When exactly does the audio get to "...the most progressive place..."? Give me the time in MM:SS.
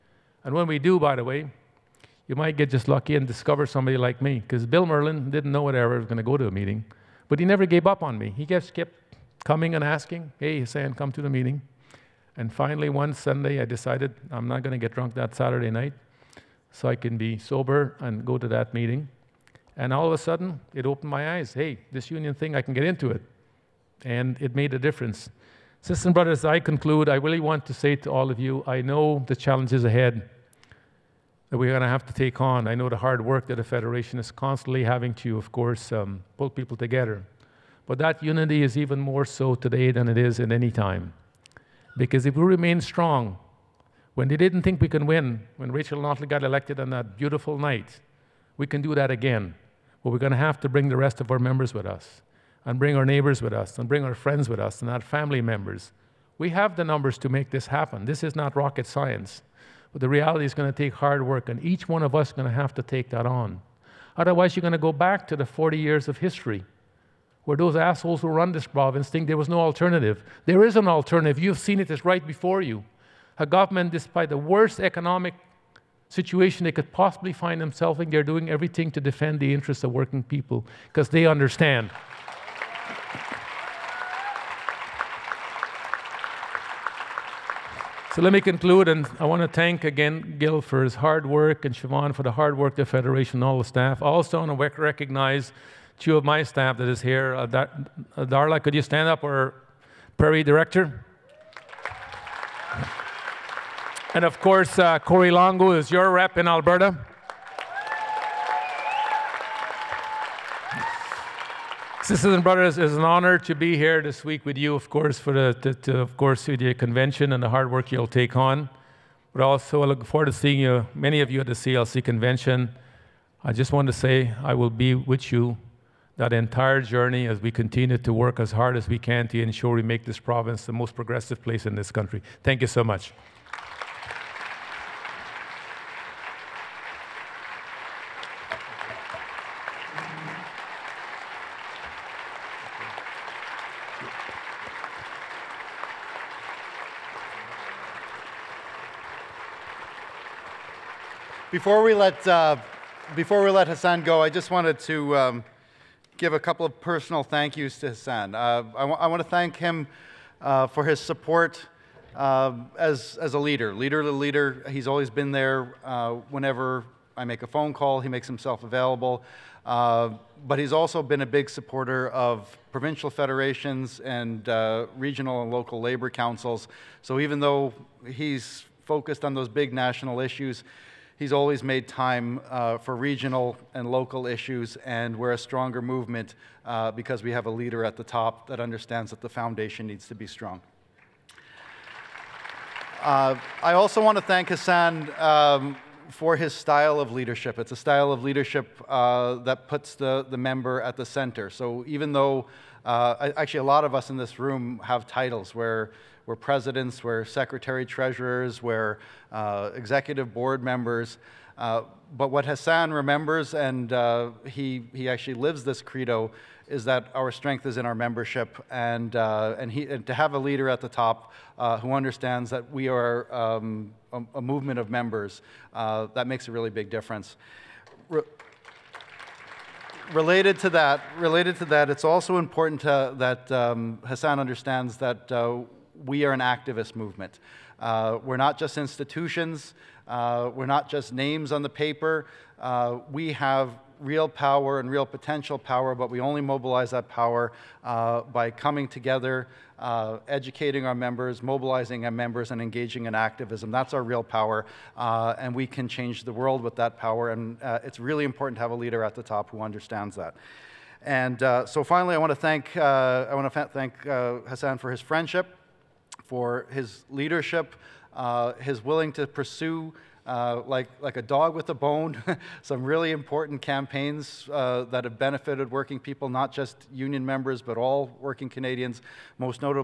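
02:10.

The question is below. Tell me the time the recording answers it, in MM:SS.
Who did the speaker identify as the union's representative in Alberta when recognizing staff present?
01:44.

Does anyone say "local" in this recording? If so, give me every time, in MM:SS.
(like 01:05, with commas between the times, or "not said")
02:55, 03:03.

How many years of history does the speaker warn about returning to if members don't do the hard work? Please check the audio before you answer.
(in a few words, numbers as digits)
40.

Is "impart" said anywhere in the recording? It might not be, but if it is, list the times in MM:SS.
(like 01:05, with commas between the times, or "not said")
not said.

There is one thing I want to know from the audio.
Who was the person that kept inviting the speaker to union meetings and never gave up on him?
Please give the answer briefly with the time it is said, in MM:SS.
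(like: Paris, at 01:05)
Bill Merlin, at 00:04.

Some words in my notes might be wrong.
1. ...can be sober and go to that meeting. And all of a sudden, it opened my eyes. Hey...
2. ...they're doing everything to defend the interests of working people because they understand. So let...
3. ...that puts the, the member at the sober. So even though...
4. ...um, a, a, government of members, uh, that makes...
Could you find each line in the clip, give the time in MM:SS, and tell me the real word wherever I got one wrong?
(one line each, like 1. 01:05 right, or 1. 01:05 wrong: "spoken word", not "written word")
1. 00:16 right
2. 01:18 right
3. 03:19 wrong: "center", not "sober"
4. 03:43 wrong: "movement", not "government".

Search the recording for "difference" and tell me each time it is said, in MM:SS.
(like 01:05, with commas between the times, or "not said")
00:24, 03:46.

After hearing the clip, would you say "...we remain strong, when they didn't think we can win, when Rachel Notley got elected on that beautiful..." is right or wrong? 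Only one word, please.
right.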